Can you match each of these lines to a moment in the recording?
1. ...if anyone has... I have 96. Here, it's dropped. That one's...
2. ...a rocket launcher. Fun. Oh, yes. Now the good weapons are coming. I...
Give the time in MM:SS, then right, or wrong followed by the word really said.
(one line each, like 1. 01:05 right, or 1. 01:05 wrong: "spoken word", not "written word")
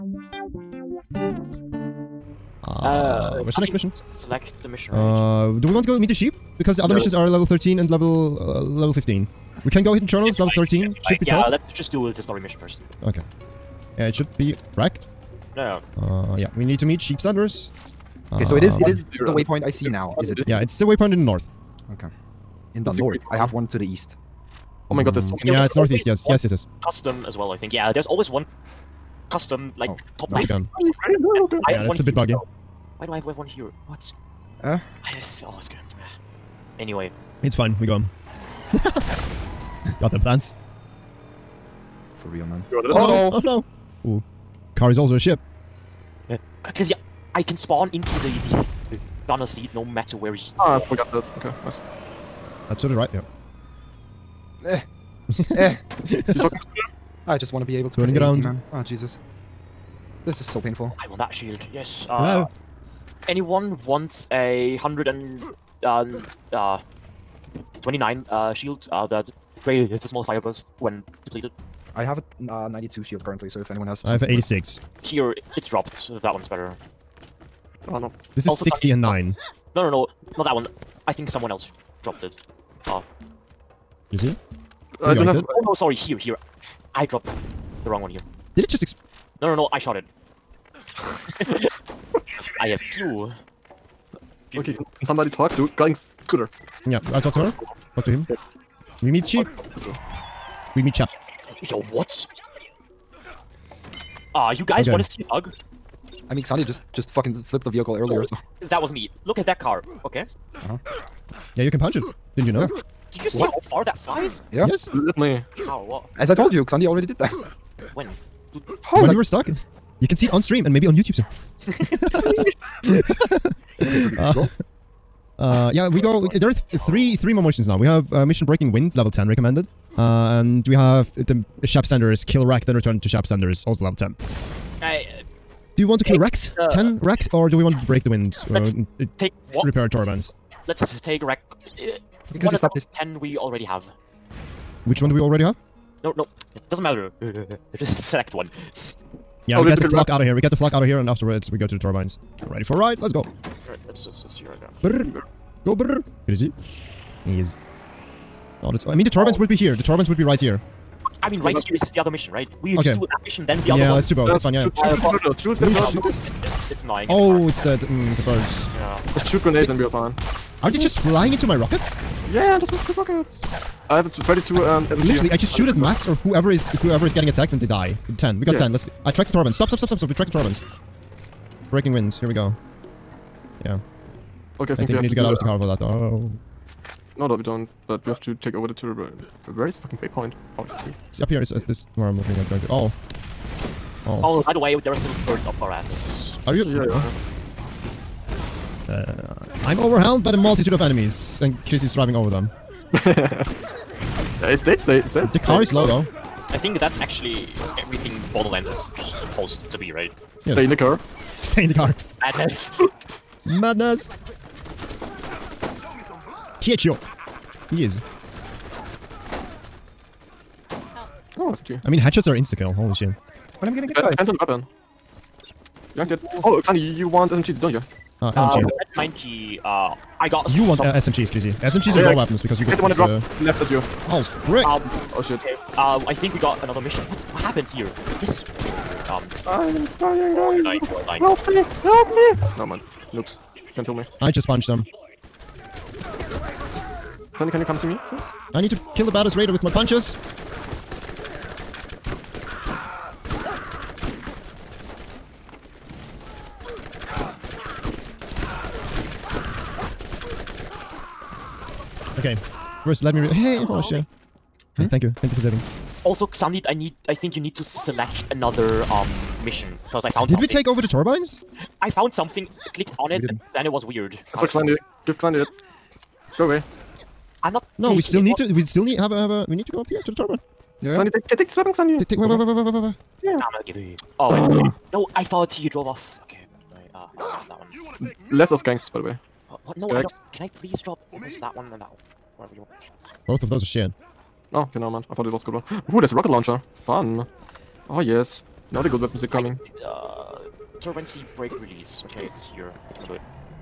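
1. 01:13 wrong: "86", not "96"
2. 04:56 right.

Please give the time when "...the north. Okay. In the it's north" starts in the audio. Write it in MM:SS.
00:21.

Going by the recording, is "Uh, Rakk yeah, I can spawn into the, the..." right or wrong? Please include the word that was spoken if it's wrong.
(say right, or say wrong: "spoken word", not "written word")
wrong: "Cause", not "Rakk".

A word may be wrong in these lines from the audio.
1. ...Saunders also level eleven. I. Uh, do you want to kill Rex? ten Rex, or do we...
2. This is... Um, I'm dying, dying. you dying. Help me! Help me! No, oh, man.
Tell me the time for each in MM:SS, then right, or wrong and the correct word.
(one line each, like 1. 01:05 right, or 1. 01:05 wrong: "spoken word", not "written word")
1. 02:13 wrong: "ten", not "eleven"
2. 03:58 right.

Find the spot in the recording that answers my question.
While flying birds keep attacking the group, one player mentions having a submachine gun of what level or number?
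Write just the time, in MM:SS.
02:53.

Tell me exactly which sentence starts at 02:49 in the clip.
Just shoot grenades they, and we are fine.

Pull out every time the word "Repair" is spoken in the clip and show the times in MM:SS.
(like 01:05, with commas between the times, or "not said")
02:19.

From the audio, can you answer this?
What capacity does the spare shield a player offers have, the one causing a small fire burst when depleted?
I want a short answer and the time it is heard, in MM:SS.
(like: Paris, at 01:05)
129, at 01:04.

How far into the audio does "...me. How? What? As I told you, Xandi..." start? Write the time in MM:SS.
01:55.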